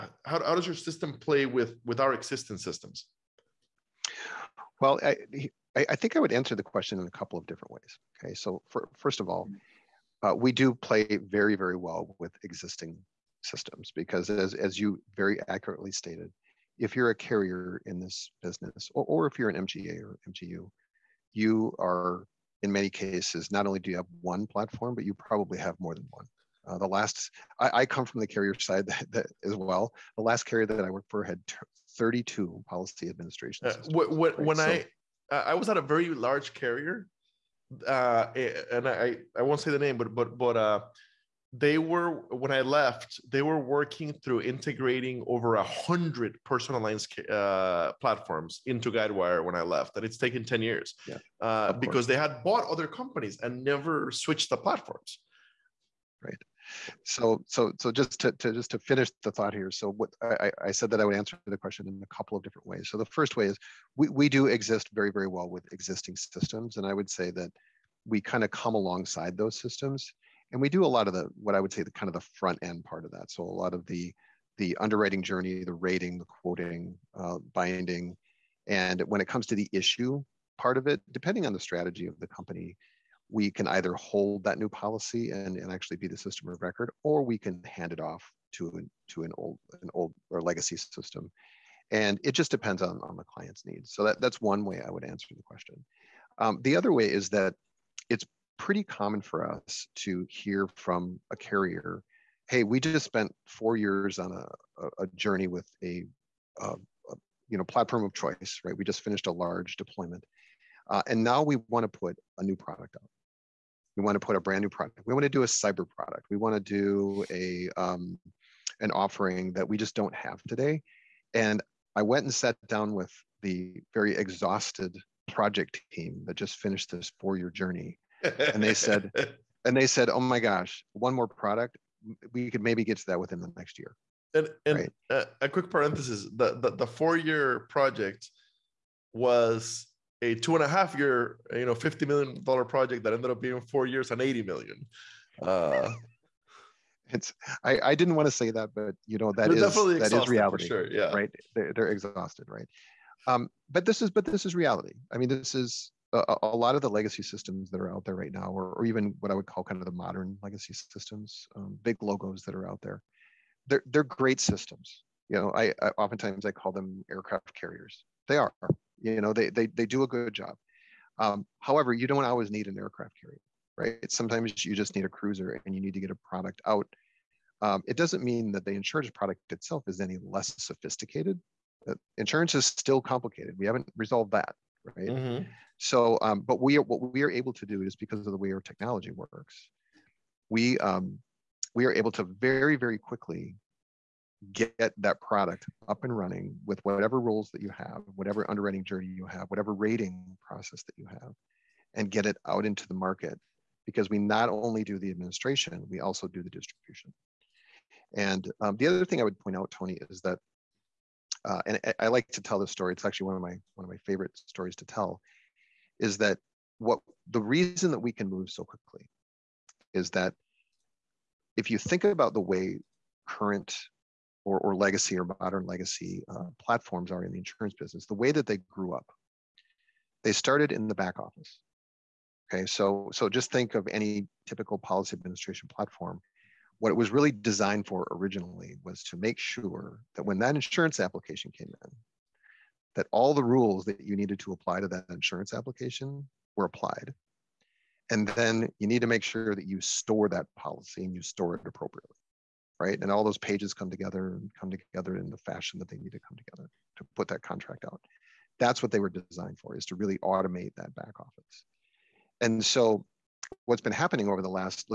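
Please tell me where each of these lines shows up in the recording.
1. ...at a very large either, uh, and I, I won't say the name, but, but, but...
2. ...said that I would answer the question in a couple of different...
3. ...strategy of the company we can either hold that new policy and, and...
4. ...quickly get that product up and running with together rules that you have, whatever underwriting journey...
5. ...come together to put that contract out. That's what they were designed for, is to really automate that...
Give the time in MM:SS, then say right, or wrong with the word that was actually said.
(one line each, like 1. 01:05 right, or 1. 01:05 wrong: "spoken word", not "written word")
1. 00:35 wrong: "carrier", not "either"
2. 01:00 right
3. 01:21 right
4. 03:12 wrong: "whatever", not "together"
5. 04:16 right.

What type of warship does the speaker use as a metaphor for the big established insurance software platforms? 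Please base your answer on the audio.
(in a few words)
aircraft carriers.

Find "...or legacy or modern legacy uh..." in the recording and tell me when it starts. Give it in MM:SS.
03:44.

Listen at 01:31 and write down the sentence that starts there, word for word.
And it just depends on, on the client's needs.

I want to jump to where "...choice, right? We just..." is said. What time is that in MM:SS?
01:48.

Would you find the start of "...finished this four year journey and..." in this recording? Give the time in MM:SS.
02:06.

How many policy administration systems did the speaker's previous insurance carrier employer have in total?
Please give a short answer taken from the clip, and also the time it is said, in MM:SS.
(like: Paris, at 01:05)
32, at 00:31.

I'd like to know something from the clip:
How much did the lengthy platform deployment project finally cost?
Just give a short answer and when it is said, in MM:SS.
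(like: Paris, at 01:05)
80 million, at 02:24.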